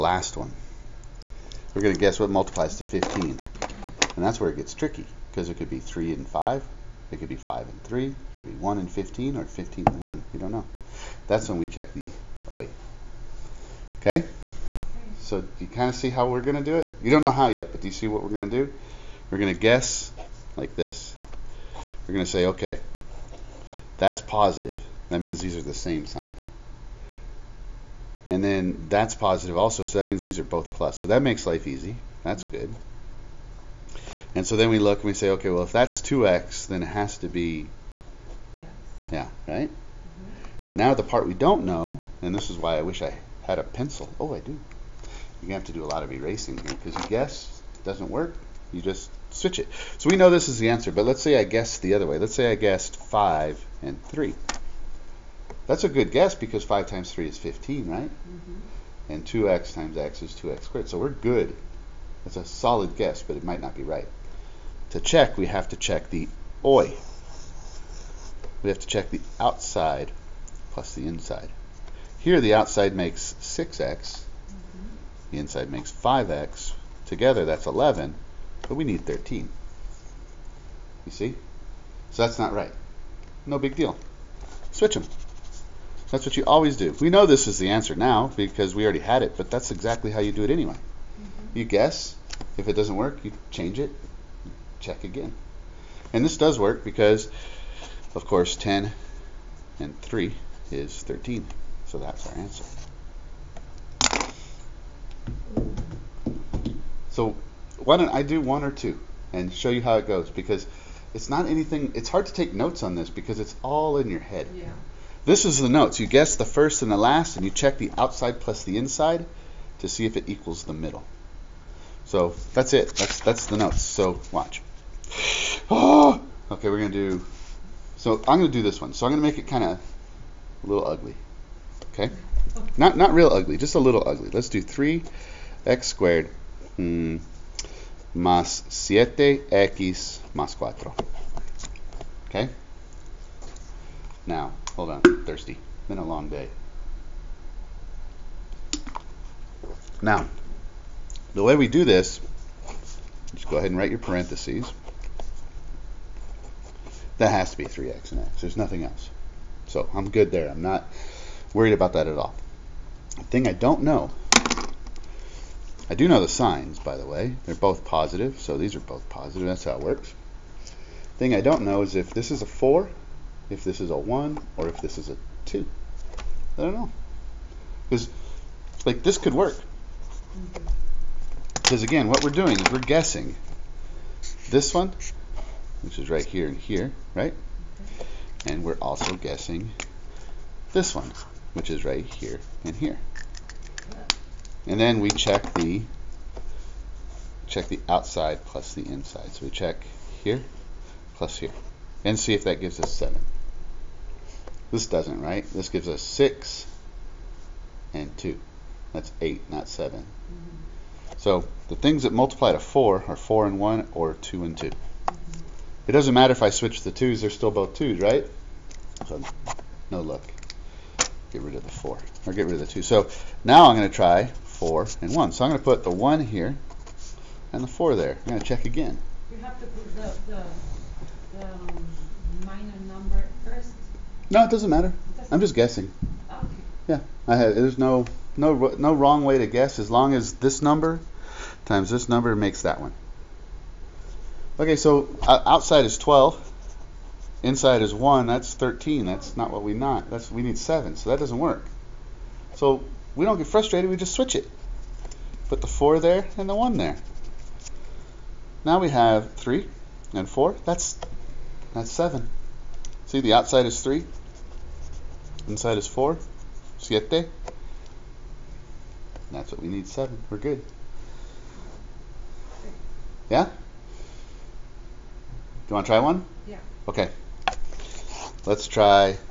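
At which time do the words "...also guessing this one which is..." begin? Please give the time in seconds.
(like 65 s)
188 s.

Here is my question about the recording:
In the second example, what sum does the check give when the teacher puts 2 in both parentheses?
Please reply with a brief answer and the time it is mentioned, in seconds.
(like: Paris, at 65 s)
8, at 208 s.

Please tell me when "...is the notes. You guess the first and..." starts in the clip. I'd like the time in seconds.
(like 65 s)
115 s.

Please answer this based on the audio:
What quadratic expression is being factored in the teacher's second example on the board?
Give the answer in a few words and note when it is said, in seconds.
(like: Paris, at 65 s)
3x^2 + 7x + 4, at 134 s.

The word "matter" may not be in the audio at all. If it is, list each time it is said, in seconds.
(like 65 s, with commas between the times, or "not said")
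216 s, 234 s.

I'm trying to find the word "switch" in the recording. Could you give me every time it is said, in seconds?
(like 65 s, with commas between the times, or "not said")
49 s, 84 s, 216 s, 254 s.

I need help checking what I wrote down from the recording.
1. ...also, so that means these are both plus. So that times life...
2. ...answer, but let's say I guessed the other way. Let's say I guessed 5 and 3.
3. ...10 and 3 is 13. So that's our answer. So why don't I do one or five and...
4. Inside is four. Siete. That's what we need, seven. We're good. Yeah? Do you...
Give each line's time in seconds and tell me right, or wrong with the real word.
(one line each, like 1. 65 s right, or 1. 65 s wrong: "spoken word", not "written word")
1. 29 s wrong: "makes", not "times"
2. 50 s right
3. 98 s wrong: "two", not "five"
4. 265 s right.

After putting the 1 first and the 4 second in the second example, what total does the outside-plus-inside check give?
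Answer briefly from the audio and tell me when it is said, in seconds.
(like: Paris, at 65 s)
13, at 248 s.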